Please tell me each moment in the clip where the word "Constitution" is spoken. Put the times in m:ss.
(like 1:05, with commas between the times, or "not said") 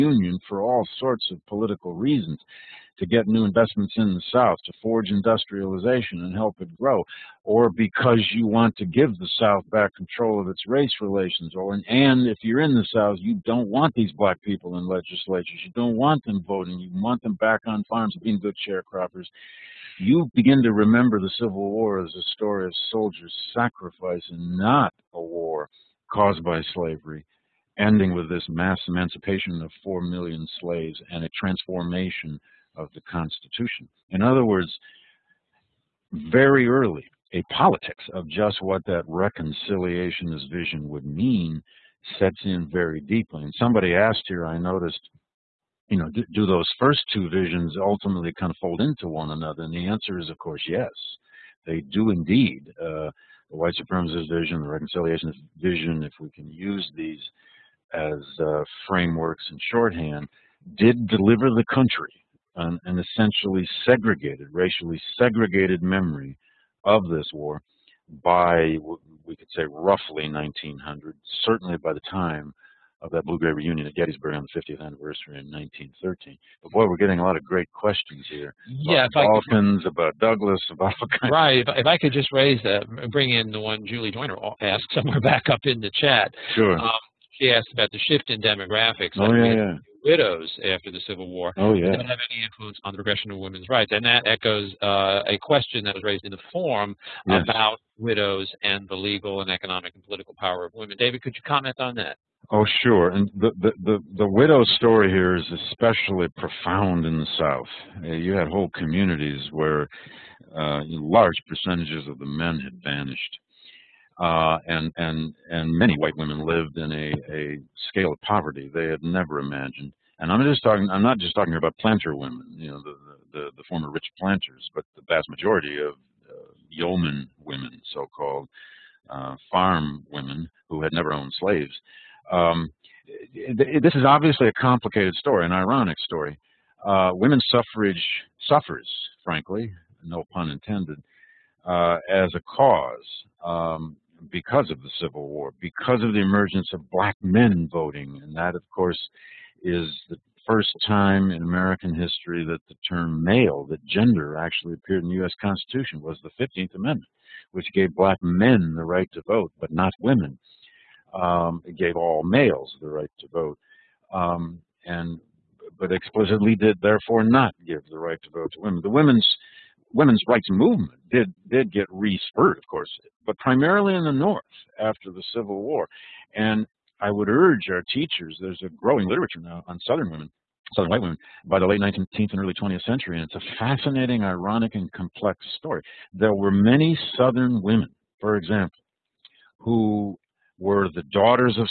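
0:33, 2:35.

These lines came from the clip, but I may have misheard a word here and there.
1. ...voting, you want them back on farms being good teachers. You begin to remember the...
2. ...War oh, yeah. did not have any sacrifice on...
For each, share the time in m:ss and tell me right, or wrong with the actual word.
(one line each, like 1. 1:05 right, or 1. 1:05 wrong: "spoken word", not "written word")
1. 0:16 wrong: "sharecroppers", not "teachers"
2. 1:31 wrong: "influence", not "sacrifice".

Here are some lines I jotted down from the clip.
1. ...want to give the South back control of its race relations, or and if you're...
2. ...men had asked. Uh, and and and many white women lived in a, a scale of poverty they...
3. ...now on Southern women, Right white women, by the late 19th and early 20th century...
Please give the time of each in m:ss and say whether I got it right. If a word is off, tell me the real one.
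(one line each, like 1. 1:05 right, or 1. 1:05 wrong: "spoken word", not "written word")
1. 0:08 right
2. 1:52 wrong: "vanished", not "asked"
3. 2:59 wrong: "Southern", not "Right".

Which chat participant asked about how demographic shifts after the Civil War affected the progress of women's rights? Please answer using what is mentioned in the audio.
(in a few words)
Julie Joyner.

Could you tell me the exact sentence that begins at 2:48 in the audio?
The women's women's rights movement did did get re-spurred, of course, but primarily in the North after the Civil War.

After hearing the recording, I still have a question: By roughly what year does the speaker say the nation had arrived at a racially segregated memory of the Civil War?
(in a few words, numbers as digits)
1900.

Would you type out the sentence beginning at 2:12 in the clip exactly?
Um, this is obviously a complicated story, an ironic story.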